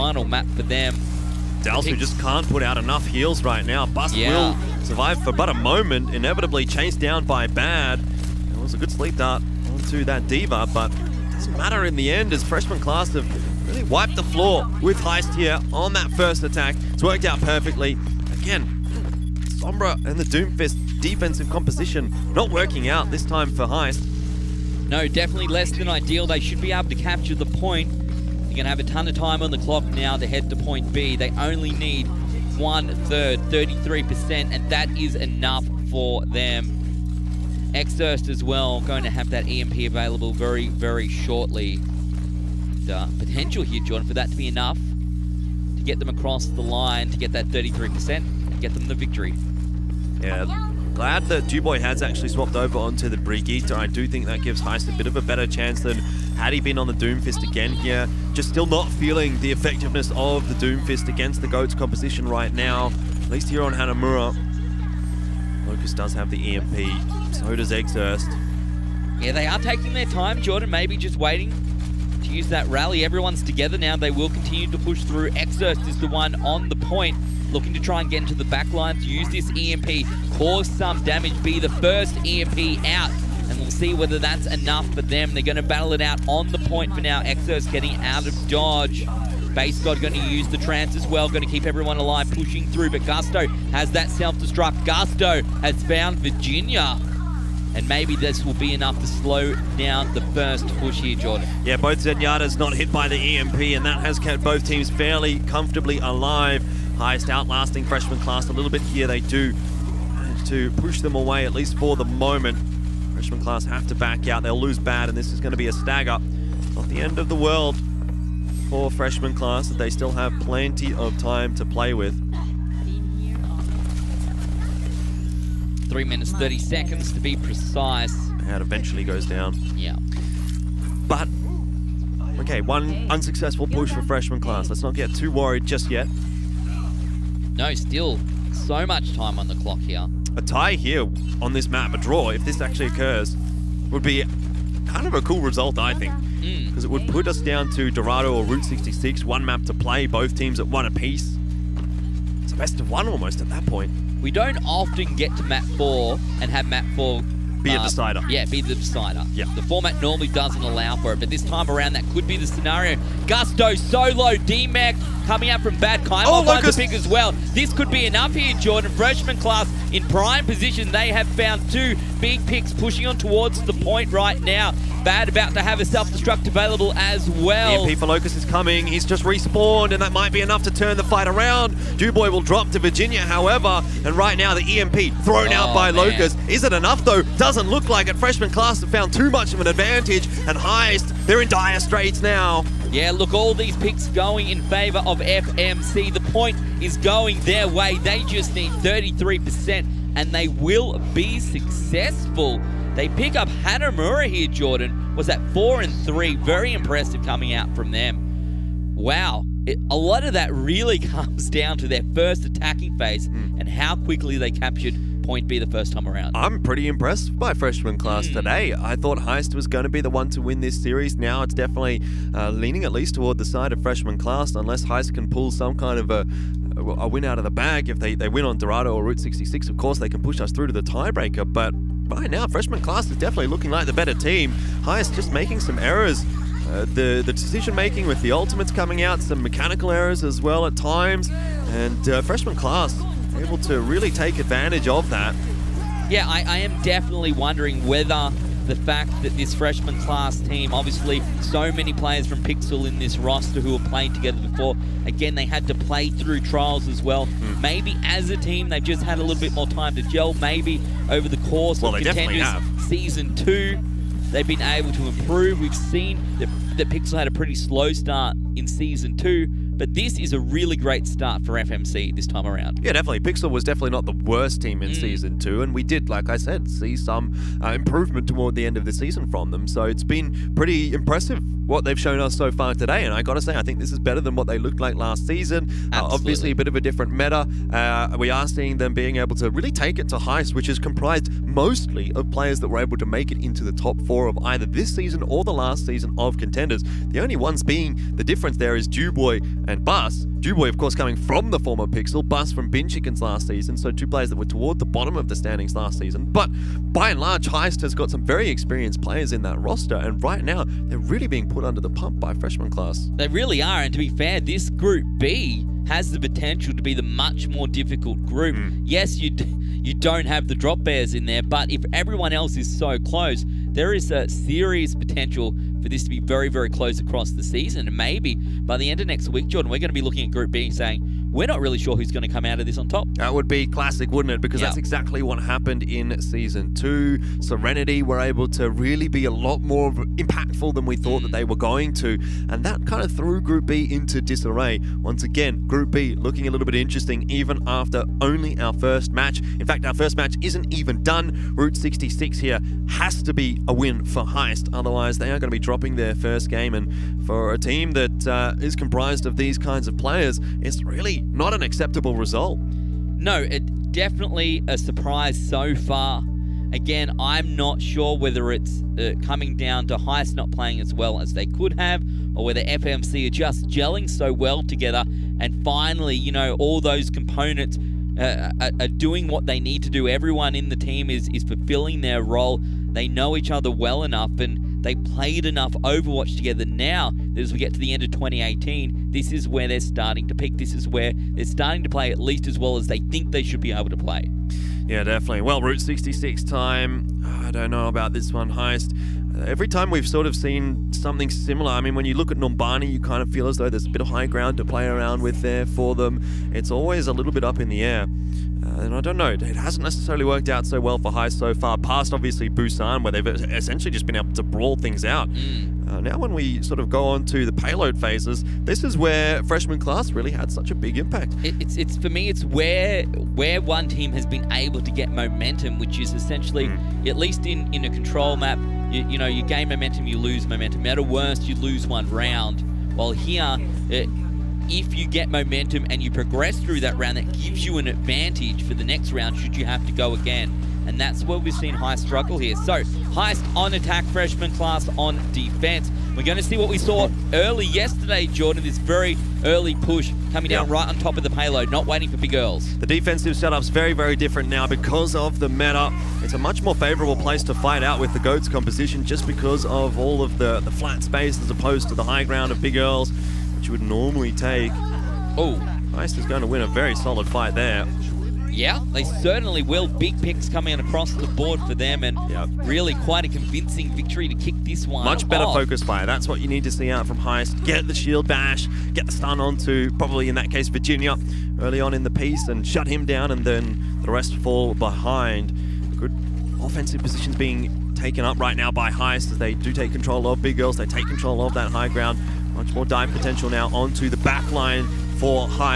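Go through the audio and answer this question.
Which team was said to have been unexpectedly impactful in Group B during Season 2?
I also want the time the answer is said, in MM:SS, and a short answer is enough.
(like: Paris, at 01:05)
Serenity, at 05:37.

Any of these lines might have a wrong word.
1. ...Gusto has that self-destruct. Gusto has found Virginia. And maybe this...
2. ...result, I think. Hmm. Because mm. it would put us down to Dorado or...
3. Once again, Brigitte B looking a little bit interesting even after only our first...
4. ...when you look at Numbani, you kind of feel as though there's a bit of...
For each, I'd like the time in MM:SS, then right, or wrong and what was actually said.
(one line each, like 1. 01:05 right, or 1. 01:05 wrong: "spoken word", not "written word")
1. 01:33 right
2. 02:25 right
3. 05:45 wrong: "Group", not "Brigitte"
4. 06:41 right.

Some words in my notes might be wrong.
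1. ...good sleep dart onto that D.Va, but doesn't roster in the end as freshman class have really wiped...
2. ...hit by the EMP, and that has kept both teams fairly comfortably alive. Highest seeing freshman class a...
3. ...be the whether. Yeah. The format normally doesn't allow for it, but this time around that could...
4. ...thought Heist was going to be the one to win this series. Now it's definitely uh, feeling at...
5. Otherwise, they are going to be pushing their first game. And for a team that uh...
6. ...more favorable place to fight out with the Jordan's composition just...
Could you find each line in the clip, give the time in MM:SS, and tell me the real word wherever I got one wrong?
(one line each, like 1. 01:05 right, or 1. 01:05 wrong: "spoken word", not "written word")
1. 00:08 wrong: "matter", not "roster"
2. 01:42 wrong: "outlasting", not "seeing"
3. 02:38 wrong: "decider", not "whether"
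4. 03:38 wrong: "leaning", not "feeling"
5. 05:54 wrong: "dropping", not "pushing"
6. 07:36 wrong: "GOAT", not "Jordan".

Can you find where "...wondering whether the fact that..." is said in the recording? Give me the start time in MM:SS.
04:07.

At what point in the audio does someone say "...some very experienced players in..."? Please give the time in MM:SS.
05:08.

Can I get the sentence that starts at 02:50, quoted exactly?
They have found two big picks pushing on towards the point right now.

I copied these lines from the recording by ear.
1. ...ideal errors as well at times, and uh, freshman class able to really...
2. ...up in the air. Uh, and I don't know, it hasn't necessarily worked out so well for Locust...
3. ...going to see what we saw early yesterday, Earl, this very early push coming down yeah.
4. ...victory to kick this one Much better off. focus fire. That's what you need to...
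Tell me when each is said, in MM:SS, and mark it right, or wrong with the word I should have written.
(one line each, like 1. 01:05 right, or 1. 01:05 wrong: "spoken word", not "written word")
1. 03:59 wrong: "mechanical", not "ideal"
2. 06:47 wrong: "Heist", not "Locust"
3. 07:26 wrong: "Jordan", not "Earl"
4. 07:53 right.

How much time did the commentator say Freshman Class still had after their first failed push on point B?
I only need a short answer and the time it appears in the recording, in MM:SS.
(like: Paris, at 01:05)
3 minutes 30 seconds, at 02:05.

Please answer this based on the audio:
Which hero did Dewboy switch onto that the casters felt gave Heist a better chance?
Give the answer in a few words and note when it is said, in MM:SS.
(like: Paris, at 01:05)
Brigitte, at 00:53.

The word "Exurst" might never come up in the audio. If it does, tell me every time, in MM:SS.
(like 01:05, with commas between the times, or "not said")
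00:37, 01:15.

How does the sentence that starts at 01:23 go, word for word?
And we'll see whether that's enough for them.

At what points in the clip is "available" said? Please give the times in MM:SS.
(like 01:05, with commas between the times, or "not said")
00:39, 02:56.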